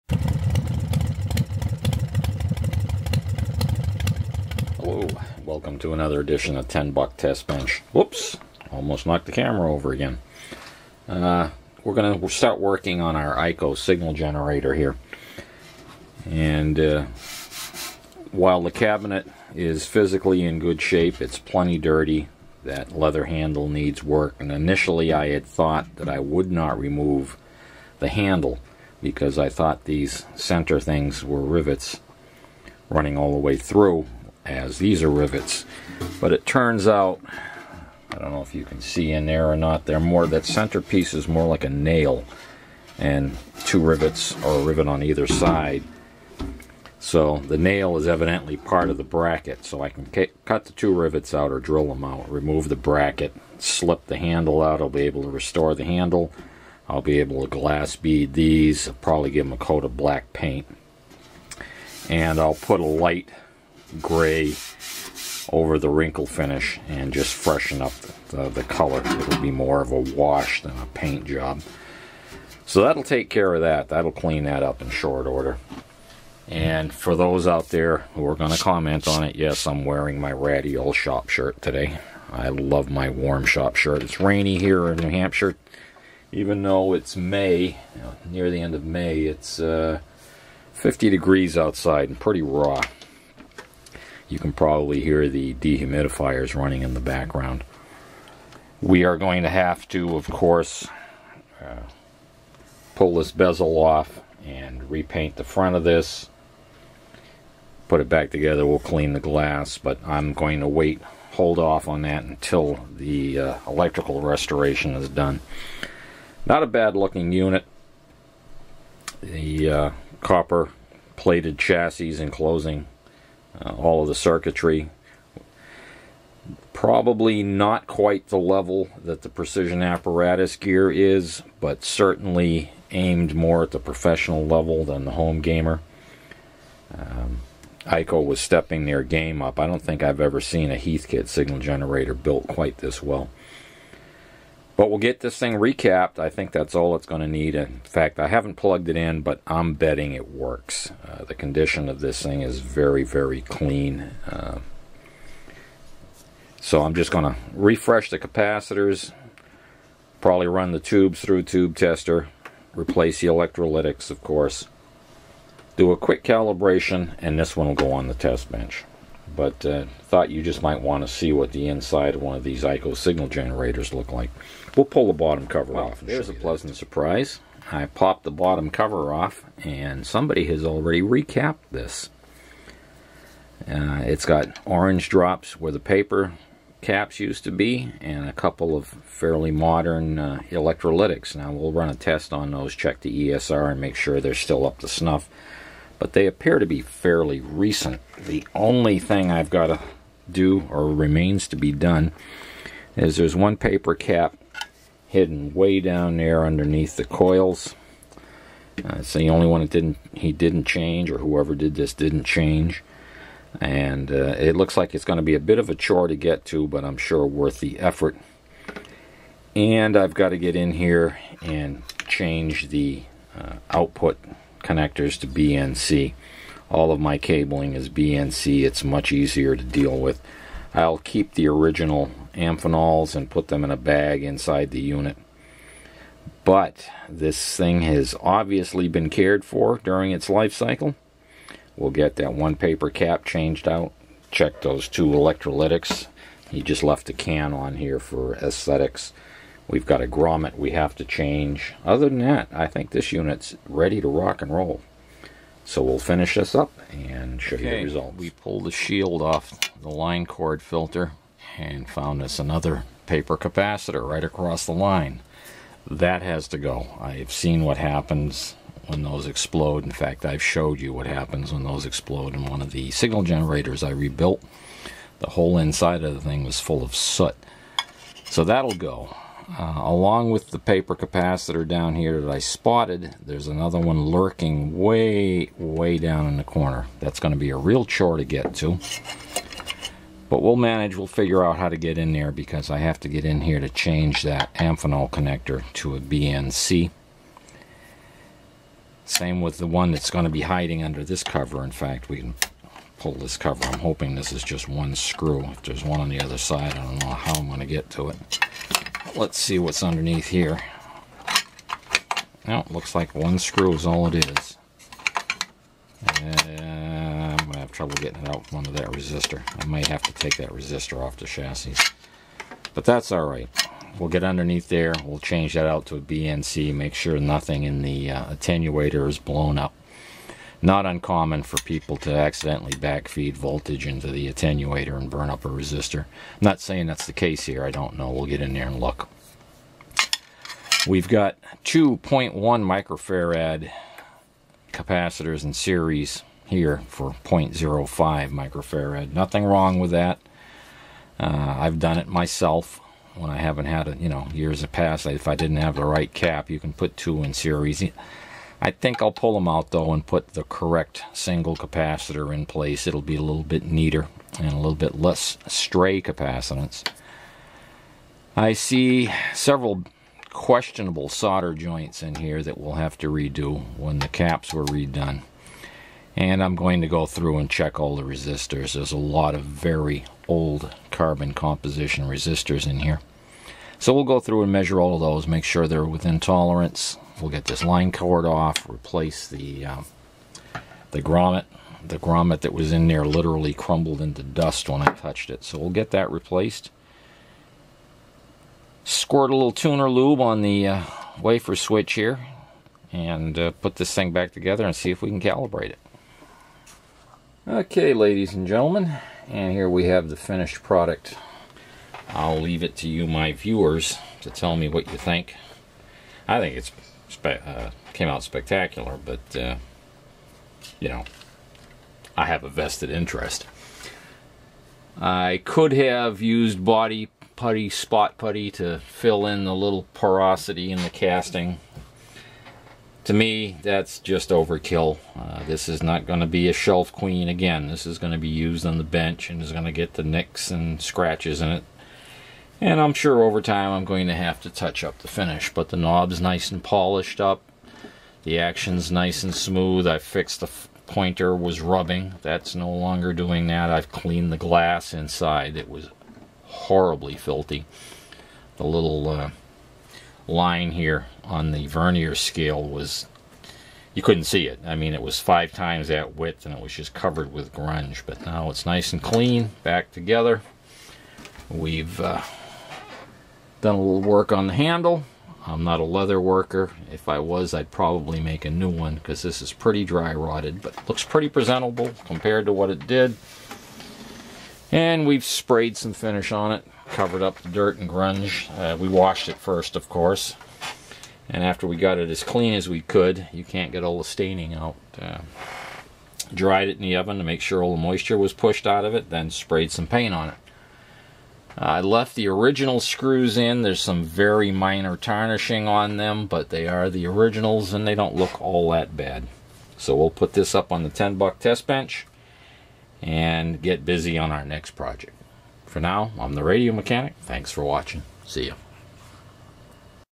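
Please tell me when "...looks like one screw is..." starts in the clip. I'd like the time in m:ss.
5:12.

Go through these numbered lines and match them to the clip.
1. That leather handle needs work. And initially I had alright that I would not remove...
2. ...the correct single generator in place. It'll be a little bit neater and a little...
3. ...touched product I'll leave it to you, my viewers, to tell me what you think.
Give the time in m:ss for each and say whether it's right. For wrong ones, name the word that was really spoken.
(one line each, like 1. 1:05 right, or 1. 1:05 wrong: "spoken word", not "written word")
1. 0:22 wrong: "thought", not "alright"
2. 6:00 wrong: "capacitor", not "generator"
3. 6:50 wrong: "finished", not "touched".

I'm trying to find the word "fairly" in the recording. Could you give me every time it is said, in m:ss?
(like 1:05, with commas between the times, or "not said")
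3:08, 3:16.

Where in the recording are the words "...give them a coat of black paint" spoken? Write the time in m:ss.
0:59.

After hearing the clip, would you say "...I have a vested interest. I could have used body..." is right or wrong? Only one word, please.
right.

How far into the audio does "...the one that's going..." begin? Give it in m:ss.
4:59.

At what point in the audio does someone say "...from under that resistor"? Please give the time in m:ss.
5:18.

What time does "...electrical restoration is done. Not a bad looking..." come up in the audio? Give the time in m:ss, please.
1:53.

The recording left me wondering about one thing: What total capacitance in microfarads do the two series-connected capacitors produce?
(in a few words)
0.05 microfarad.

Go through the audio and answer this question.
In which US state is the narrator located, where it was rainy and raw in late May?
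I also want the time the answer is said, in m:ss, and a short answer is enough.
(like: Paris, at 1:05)
New Hampshire, at 1:24.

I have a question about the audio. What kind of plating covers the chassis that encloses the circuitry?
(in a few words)
Copper.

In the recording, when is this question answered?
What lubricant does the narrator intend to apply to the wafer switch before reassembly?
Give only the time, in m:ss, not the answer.
6:39.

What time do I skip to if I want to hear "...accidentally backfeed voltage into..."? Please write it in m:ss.
5:32.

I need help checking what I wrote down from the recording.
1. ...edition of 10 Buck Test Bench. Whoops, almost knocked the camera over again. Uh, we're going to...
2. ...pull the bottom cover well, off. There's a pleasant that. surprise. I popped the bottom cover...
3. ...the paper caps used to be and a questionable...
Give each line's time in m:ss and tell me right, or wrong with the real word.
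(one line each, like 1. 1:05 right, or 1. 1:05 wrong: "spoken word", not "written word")
1. 0:06 right
2. 2:54 right
3. 3:05 wrong: "couple", not "questionable".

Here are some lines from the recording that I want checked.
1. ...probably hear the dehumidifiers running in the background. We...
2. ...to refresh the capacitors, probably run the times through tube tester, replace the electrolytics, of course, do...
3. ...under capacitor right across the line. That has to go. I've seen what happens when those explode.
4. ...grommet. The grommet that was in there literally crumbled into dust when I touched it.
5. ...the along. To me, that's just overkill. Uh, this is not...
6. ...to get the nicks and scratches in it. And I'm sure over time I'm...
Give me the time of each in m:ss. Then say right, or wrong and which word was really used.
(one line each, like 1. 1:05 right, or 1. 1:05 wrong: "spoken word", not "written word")
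1. 1:34 right
2. 2:37 wrong: "tubes", not "times"
3. 4:23 wrong: "paper", not "under"
4. 6:31 right
5. 7:10 wrong: "casting", not "along"
6. 7:19 right.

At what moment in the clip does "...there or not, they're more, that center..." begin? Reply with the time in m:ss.
0:39.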